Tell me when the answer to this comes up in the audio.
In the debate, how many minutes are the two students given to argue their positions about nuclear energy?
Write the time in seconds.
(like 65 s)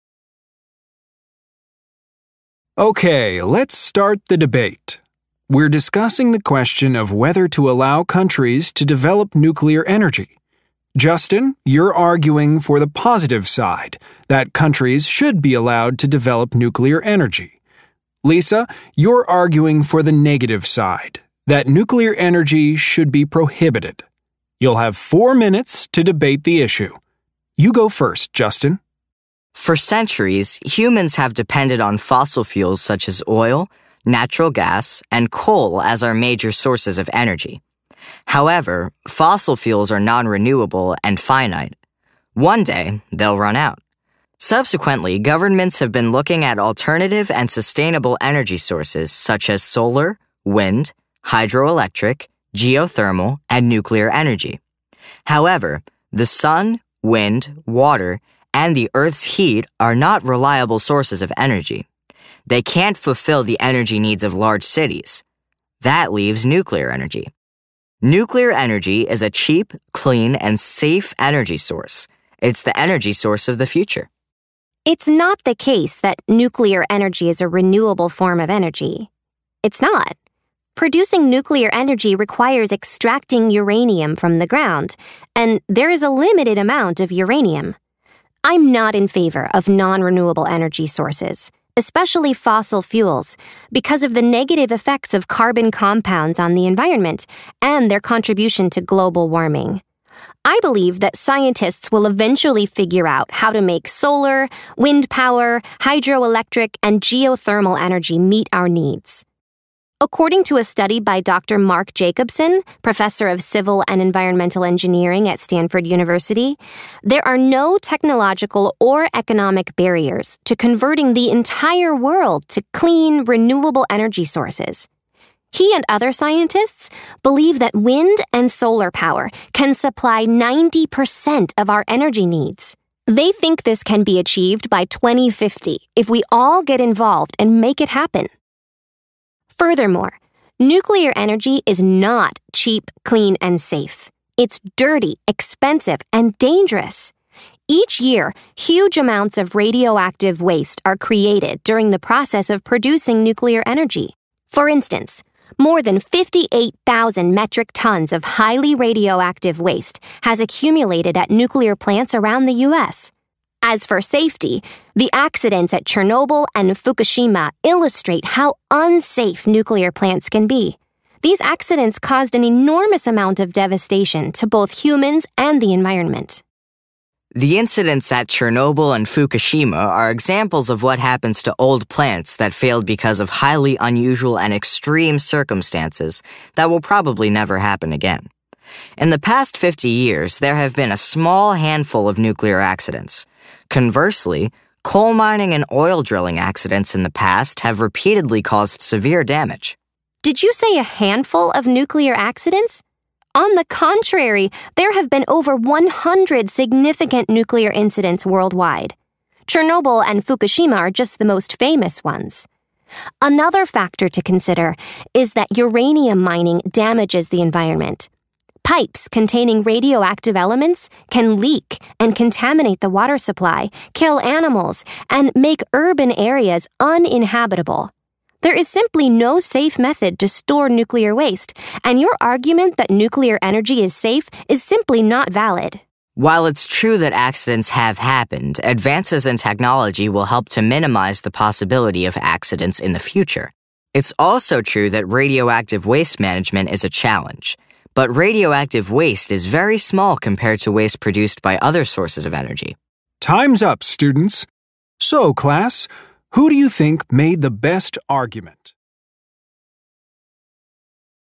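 24 s.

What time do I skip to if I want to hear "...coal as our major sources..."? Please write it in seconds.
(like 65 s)
35 s.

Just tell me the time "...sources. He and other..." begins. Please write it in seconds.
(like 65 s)
124 s.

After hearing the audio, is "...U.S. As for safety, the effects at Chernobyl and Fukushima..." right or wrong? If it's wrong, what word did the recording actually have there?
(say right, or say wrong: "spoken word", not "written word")
wrong: "accidents", not "effects".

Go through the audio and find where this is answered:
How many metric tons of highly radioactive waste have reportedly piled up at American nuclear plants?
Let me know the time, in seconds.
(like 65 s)
155 s.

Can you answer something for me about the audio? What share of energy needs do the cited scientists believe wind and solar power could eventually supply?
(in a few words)
90%.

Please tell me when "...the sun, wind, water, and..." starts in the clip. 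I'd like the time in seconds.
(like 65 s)
56 s.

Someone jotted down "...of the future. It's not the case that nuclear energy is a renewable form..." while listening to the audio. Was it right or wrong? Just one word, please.
right.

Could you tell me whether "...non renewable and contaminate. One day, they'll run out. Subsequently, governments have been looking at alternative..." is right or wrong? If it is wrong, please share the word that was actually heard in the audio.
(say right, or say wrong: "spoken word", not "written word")
wrong: "finite", not "contaminate".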